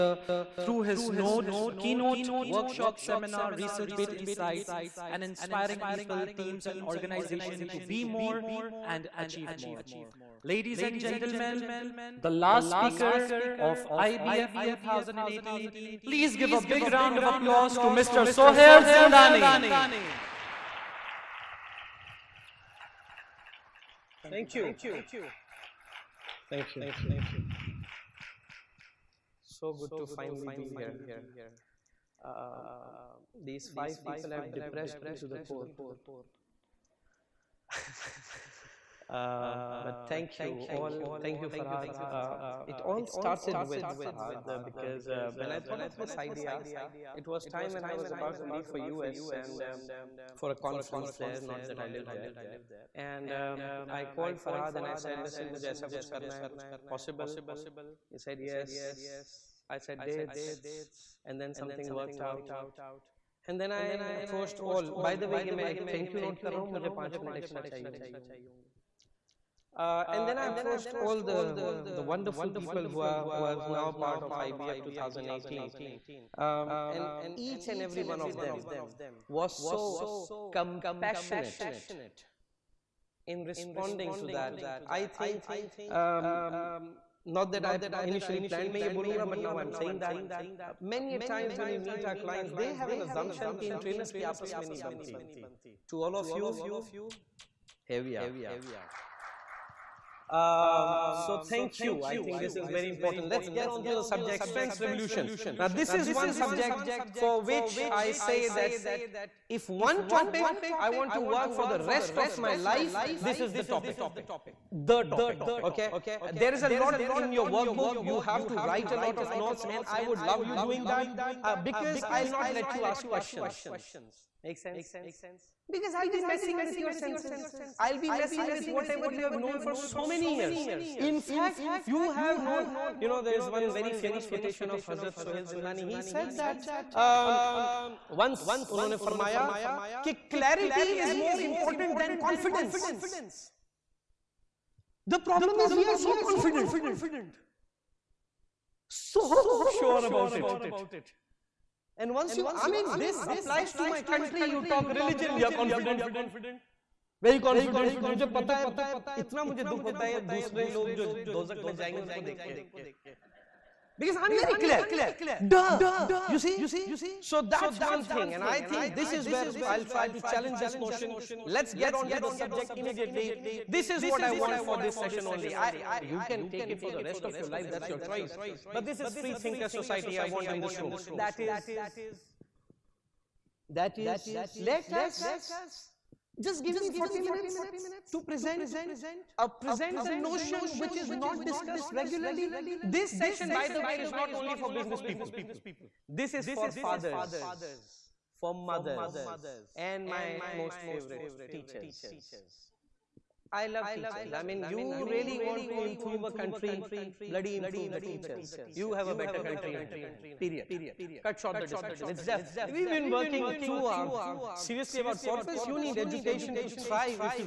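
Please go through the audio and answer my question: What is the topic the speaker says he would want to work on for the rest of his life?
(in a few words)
Strengths revolution.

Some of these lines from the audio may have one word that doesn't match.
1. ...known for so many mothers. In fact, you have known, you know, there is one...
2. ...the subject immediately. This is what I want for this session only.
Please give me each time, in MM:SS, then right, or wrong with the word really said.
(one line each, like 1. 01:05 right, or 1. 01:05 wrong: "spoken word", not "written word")
1. 02:09 wrong: "years", not "mothers"
2. 02:52 right.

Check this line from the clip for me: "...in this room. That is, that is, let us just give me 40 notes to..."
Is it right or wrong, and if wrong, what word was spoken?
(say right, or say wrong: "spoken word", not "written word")
wrong: "minutes", not "notes".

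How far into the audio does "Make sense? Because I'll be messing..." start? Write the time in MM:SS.
02:04.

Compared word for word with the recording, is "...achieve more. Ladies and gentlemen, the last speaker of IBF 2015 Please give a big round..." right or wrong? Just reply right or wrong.
wrong.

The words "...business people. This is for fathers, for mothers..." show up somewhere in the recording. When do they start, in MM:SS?
03:14.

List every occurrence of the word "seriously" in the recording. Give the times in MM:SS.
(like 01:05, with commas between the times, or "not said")
03:34.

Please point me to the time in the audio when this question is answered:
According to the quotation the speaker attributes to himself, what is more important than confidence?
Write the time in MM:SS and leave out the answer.
02:20.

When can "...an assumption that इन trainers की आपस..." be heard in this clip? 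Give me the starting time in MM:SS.
01:32.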